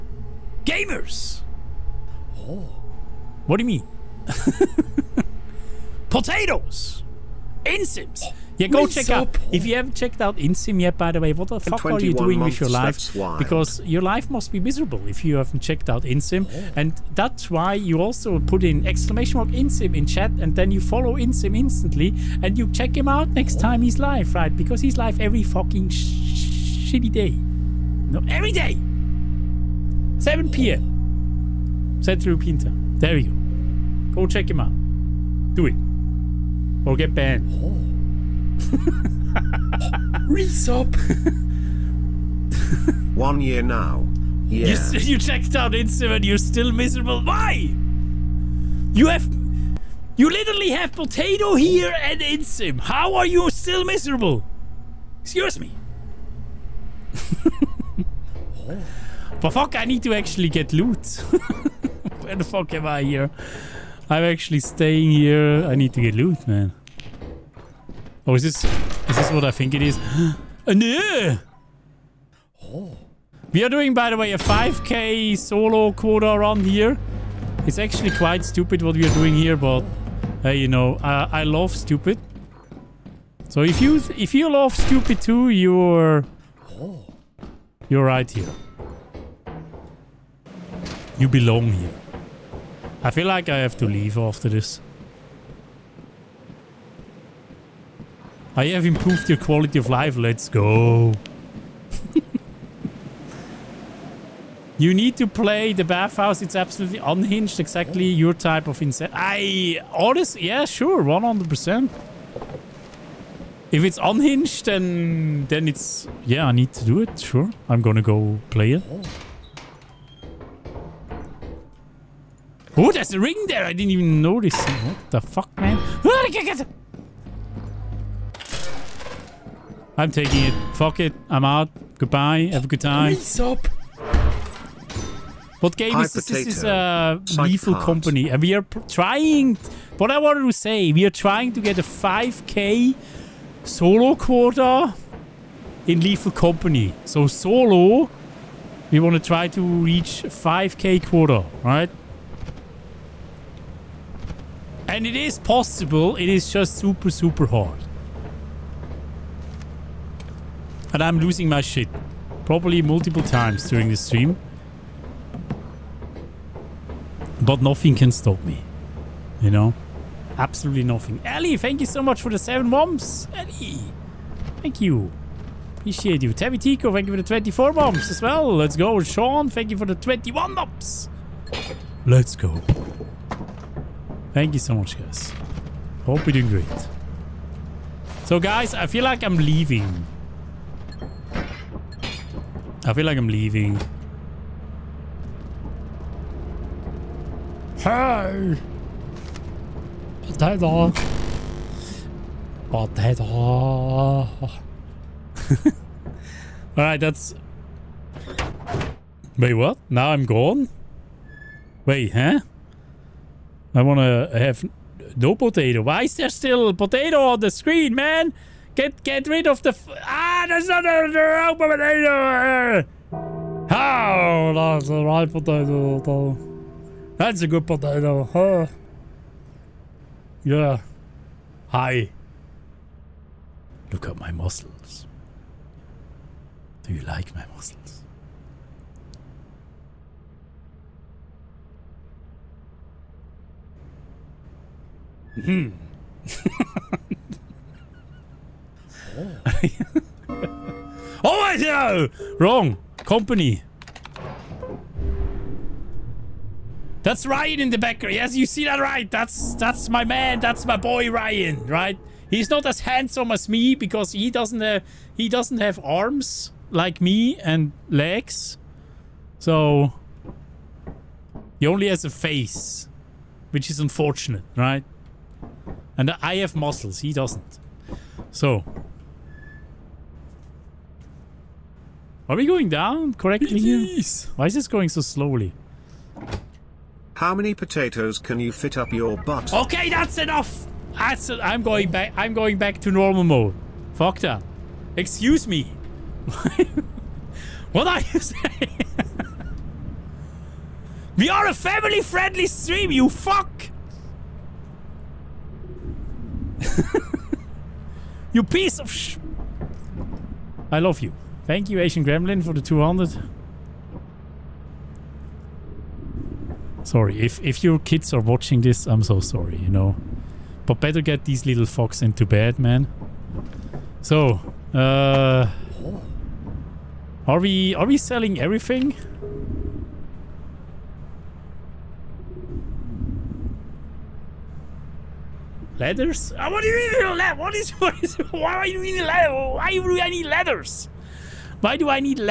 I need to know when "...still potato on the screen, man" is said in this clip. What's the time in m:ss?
3:36.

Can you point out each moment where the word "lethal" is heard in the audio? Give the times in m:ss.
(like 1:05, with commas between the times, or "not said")
2:17, 2:26.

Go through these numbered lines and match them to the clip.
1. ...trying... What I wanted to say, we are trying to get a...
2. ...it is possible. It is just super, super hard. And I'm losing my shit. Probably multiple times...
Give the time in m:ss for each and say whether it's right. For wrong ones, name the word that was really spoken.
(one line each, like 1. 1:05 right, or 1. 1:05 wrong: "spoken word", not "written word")
1. 2:18 right
2. 2:35 right.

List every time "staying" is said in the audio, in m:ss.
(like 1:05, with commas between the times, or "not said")
1:04.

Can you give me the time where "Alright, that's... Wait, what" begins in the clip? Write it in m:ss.
3:26.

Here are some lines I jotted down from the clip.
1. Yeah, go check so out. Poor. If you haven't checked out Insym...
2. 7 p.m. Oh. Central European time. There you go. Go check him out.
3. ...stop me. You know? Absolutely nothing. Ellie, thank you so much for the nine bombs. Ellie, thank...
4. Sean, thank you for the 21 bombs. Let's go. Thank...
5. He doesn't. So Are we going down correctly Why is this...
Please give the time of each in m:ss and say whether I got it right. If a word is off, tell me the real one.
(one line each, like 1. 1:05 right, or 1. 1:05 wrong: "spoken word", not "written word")
1. 0:08 right
2. 0:30 right
3. 2:48 wrong: "seven", not "nine"
4. 2:59 right
5. 4:37 right.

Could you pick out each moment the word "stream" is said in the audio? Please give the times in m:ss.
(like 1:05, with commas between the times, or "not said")
2:43, 5:02.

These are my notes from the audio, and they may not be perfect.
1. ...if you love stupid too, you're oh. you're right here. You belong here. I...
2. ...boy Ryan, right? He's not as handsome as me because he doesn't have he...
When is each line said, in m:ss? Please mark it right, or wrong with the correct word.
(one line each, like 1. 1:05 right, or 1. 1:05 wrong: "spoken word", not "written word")
1. 1:24 right
2. 4:20 right.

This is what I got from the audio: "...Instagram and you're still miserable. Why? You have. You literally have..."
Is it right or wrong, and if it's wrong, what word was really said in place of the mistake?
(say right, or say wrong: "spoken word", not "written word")
right.